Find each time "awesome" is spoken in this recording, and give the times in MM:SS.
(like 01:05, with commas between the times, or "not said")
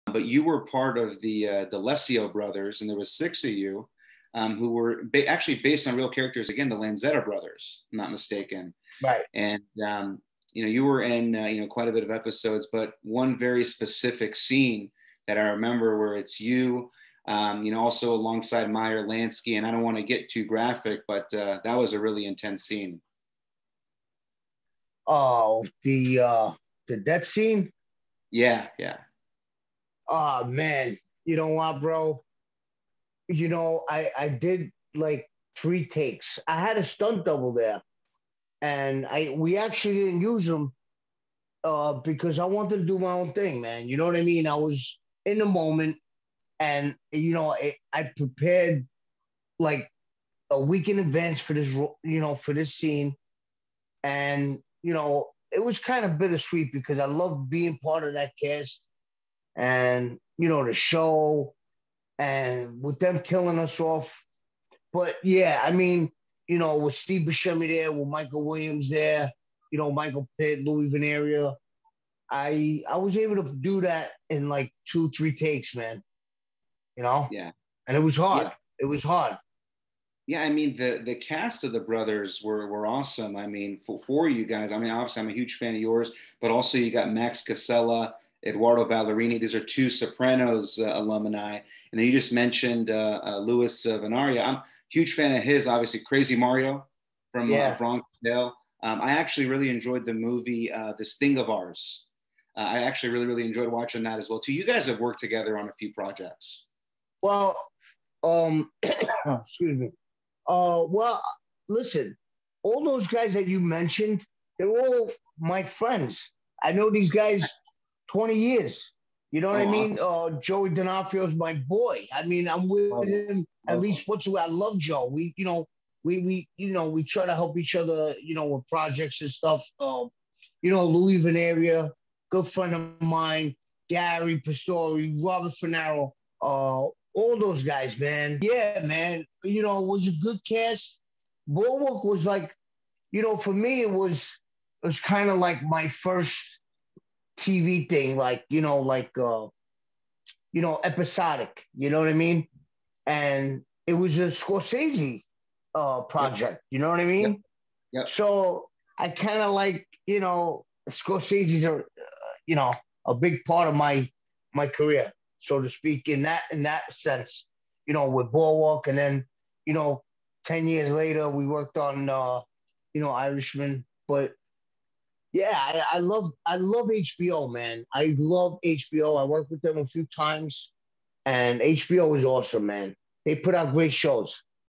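01:22, 01:59, 03:02.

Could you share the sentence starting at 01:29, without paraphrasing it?
These are two Sopranos uh, alumni.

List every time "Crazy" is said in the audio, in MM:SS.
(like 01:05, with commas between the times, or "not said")
01:36.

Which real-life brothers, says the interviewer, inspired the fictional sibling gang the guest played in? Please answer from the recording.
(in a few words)
Lanzetta brothers.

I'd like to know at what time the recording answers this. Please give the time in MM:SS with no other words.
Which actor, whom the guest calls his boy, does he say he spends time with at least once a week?
02:00.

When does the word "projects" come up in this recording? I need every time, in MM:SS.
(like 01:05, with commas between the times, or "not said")
01:45, 02:08, 02:36.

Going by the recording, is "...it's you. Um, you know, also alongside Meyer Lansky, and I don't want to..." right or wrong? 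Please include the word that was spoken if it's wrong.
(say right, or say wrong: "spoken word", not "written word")
right.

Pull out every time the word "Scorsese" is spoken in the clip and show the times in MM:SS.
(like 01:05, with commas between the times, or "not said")
02:34, 02:40.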